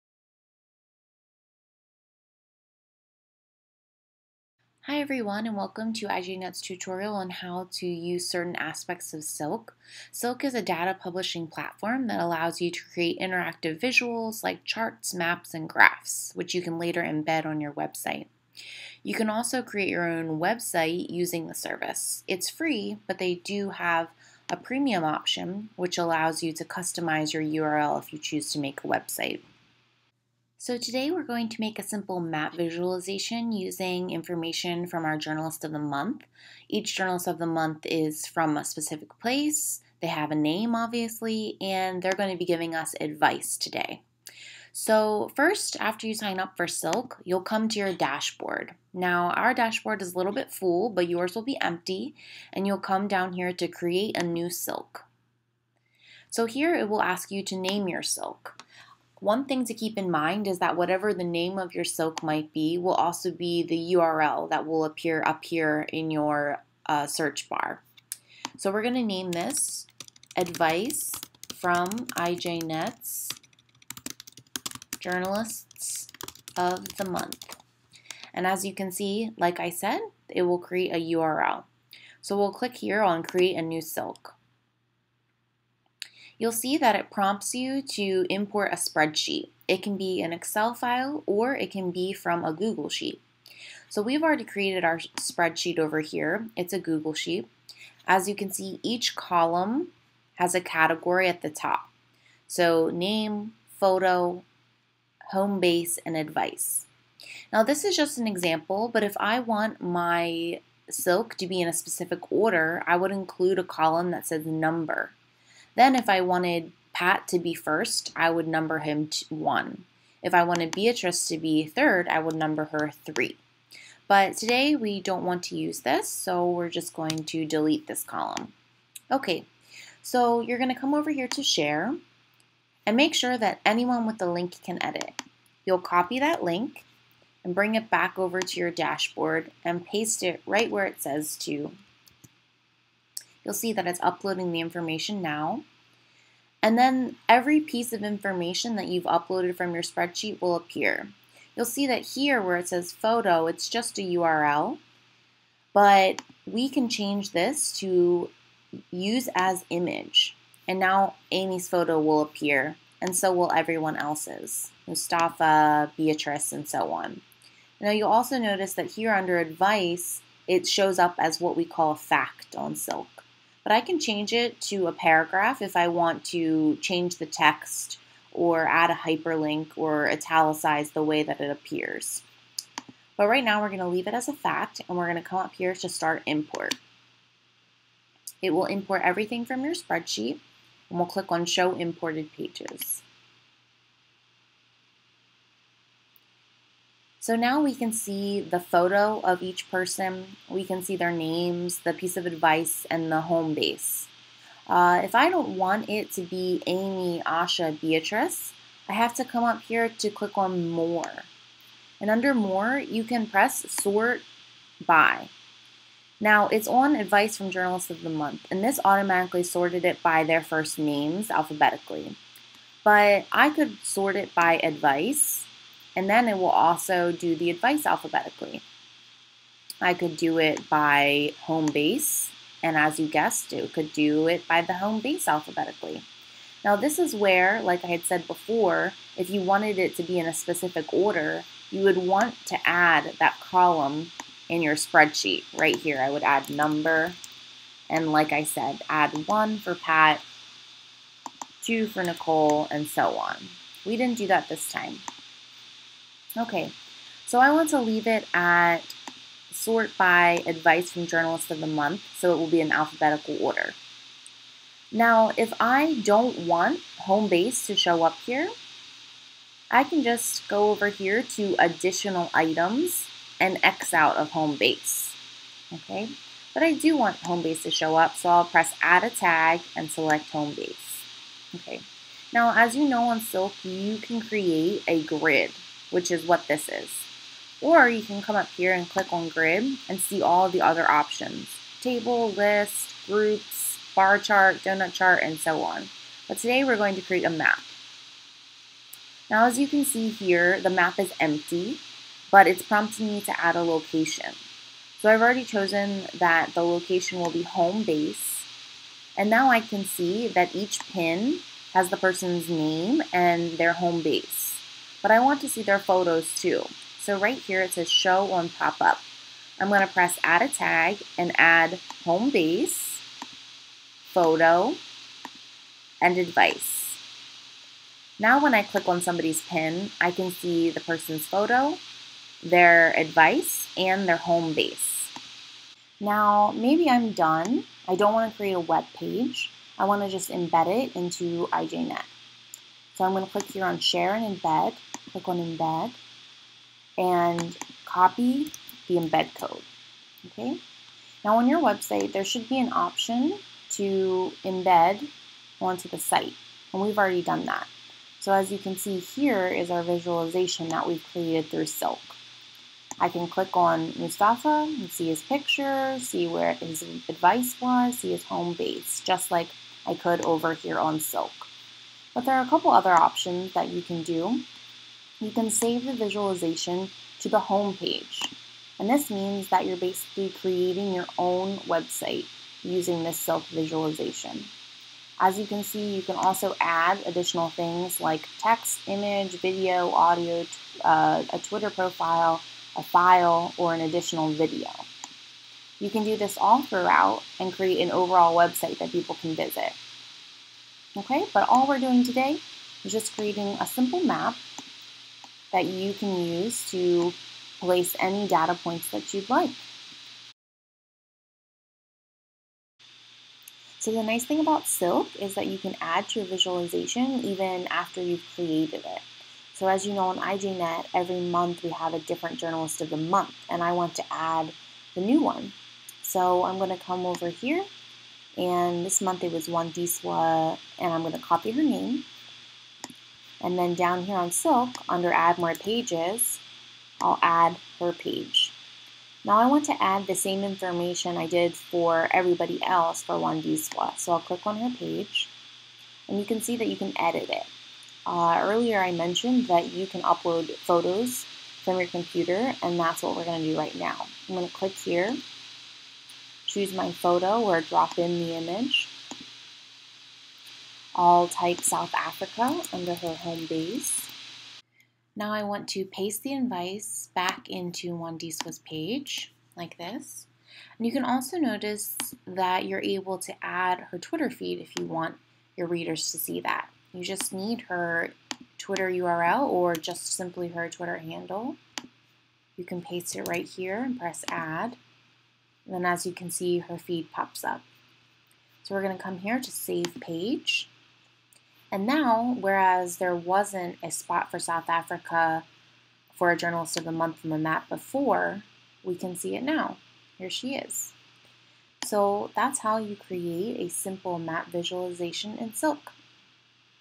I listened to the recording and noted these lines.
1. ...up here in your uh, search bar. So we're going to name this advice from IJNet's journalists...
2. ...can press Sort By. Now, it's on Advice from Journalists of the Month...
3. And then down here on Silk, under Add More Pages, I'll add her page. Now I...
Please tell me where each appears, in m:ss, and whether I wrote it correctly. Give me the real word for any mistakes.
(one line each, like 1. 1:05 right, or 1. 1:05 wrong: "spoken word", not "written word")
1. 1:05 right
2. 3:33 right
3. 7:13 right.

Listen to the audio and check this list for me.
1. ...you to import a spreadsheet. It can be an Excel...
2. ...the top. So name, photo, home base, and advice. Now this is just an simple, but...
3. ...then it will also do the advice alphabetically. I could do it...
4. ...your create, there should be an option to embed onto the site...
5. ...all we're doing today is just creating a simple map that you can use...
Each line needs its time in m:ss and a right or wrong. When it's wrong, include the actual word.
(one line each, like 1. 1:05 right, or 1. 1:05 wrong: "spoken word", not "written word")
1. 1:27 right
2. 1:41 wrong: "example", not "simple"
3. 3:46 right
4. 5:51 wrong: "website", not "create"
5. 6:41 right.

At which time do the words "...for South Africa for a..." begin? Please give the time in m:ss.
8:14.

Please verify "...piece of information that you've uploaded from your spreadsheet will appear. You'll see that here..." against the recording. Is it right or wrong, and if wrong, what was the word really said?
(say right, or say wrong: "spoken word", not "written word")
right.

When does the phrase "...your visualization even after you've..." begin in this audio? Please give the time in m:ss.
6:56.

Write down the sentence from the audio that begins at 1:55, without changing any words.
Then, if I wanted Pat to be first, I would number him one.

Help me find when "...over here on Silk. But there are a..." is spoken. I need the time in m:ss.
6:10.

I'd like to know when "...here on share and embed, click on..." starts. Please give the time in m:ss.
5:43.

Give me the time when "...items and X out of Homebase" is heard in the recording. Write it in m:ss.
4:32.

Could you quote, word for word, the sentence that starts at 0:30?
So today we're going to make a simple map visualization using information from our Journalist of the Month.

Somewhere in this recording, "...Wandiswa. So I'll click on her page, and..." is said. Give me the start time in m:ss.
7:23.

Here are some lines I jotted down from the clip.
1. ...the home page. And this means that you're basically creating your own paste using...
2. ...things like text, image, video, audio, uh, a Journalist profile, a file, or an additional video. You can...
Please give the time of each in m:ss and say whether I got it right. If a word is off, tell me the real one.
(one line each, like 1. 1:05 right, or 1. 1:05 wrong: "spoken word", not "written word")
1. 6:17 wrong: "website", not "paste"
2. 6:27 wrong: "Twitter", not "Journalist".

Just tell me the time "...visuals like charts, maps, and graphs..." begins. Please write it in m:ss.
0:13.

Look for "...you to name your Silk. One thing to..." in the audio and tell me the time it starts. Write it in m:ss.
0:57.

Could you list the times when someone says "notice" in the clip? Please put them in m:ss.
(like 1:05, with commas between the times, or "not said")
2:48, 7:51.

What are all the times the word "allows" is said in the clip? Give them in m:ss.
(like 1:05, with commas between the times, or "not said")
0:12, 0:25.